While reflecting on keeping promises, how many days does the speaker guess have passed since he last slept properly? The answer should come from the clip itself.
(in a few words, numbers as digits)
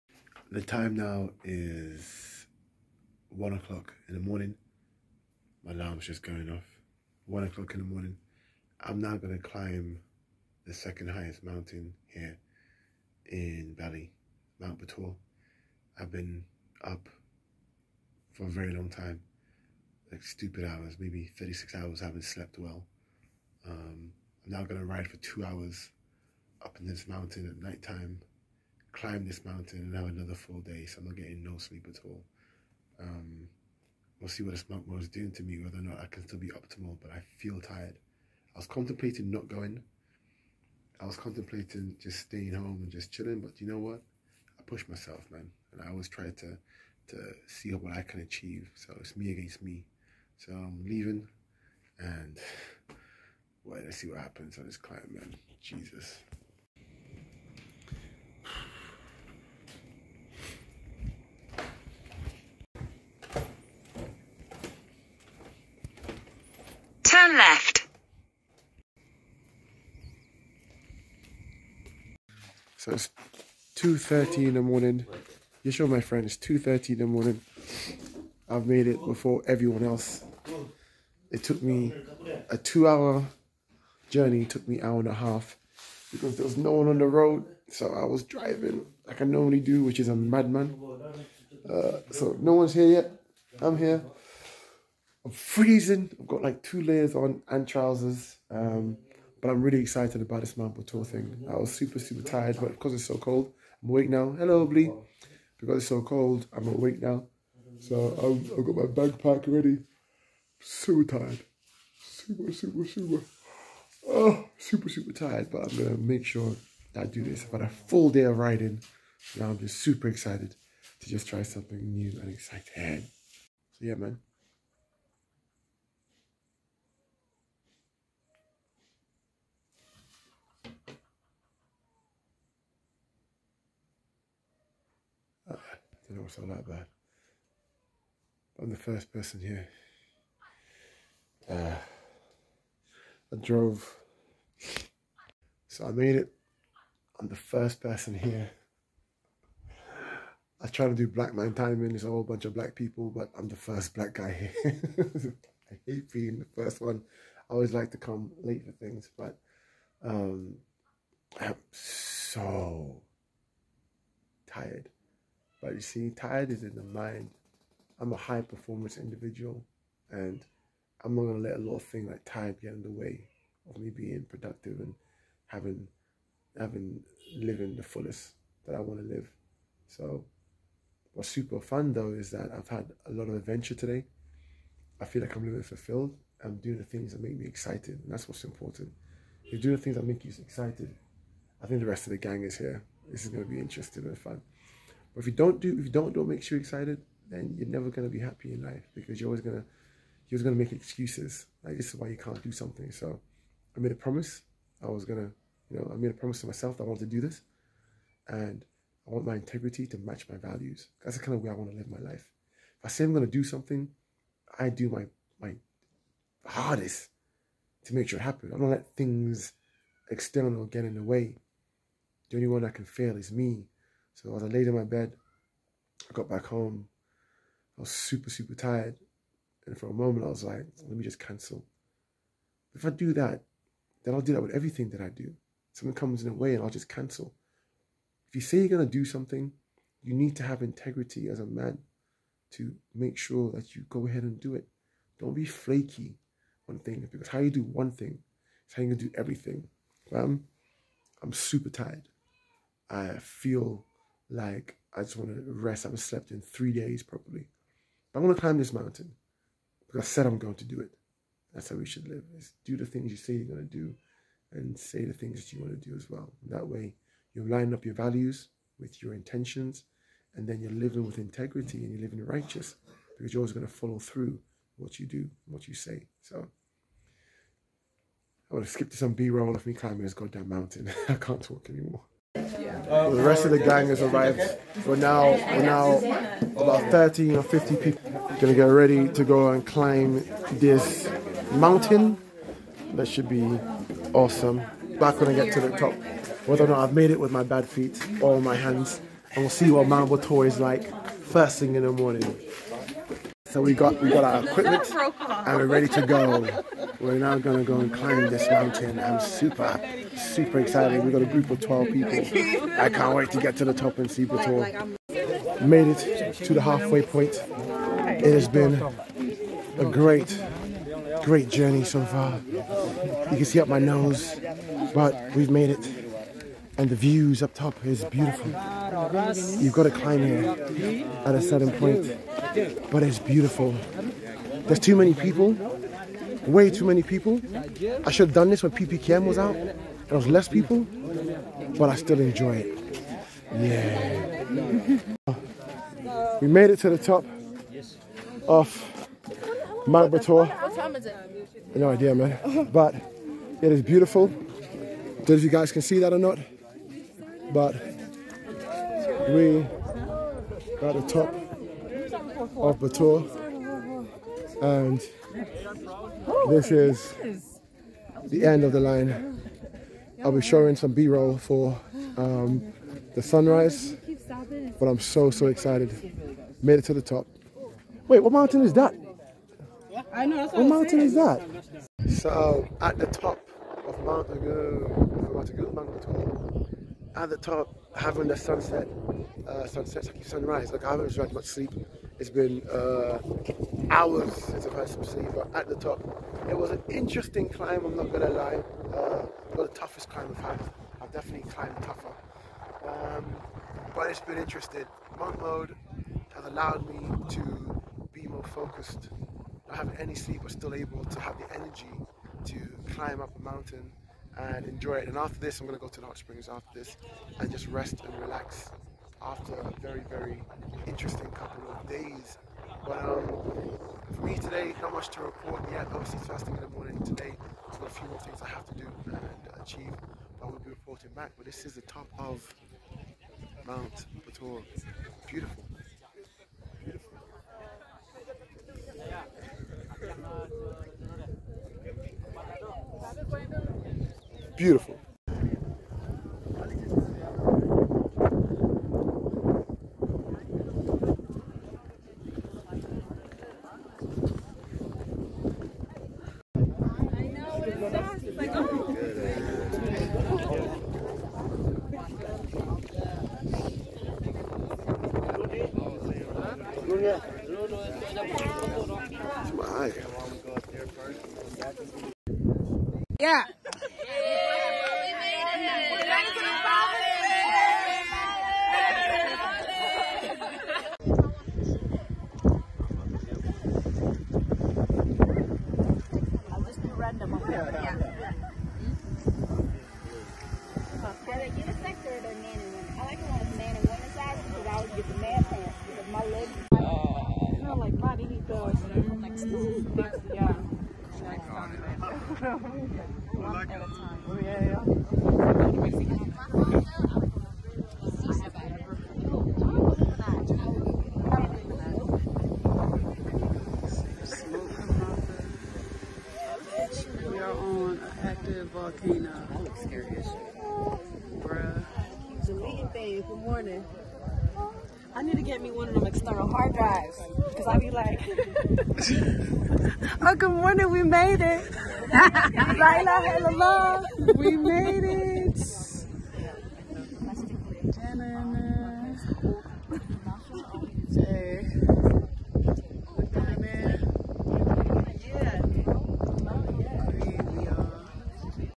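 3.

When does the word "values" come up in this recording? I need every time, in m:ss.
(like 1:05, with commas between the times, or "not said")
3:30, 4:27.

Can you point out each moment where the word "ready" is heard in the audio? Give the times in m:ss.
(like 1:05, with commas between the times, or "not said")
1:49, 4:48, 5:05.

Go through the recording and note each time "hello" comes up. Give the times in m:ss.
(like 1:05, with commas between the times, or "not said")
1:44, 8:54.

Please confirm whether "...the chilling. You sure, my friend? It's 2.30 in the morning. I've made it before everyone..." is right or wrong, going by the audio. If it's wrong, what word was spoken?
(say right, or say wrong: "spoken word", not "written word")
wrong: "morning", not "chilling".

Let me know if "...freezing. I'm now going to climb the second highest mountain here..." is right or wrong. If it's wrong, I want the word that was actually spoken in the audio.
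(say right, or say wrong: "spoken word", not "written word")
wrong: "morning", not "freezing".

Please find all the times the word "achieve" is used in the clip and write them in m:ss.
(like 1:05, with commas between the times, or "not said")
0:48, 7:09.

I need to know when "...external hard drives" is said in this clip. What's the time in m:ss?
8:46.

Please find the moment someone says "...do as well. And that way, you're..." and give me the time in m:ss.
4:25.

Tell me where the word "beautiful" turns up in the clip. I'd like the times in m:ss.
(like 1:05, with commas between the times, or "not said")
5:28, 5:33, 5:53, 7:15.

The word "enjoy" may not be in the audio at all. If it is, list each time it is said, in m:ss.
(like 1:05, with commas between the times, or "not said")
5:42, 6:54.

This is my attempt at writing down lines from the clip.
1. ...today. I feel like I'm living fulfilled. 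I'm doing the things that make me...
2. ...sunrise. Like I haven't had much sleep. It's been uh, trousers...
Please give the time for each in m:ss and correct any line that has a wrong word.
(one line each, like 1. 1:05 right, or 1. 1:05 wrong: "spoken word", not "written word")
1. 3:03 right
2. 6:30 wrong: "hours", not "trousers".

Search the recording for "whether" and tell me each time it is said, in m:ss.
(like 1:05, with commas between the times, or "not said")
0:35, 4:56.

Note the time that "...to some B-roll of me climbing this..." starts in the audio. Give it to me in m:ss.
4:38.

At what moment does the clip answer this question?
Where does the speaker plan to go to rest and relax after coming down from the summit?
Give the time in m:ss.
6:56.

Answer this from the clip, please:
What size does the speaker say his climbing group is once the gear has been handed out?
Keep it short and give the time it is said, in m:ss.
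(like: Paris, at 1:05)
12 people, at 5:11.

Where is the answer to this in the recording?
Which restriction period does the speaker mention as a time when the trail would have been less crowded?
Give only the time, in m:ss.
5:38.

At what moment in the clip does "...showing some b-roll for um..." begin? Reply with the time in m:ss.
6:10.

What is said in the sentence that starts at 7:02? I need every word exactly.
But um, for me today, not much to report yet.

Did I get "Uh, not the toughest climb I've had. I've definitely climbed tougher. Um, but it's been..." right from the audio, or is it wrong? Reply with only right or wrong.
right.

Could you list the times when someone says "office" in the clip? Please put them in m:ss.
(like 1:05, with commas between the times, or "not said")
not said.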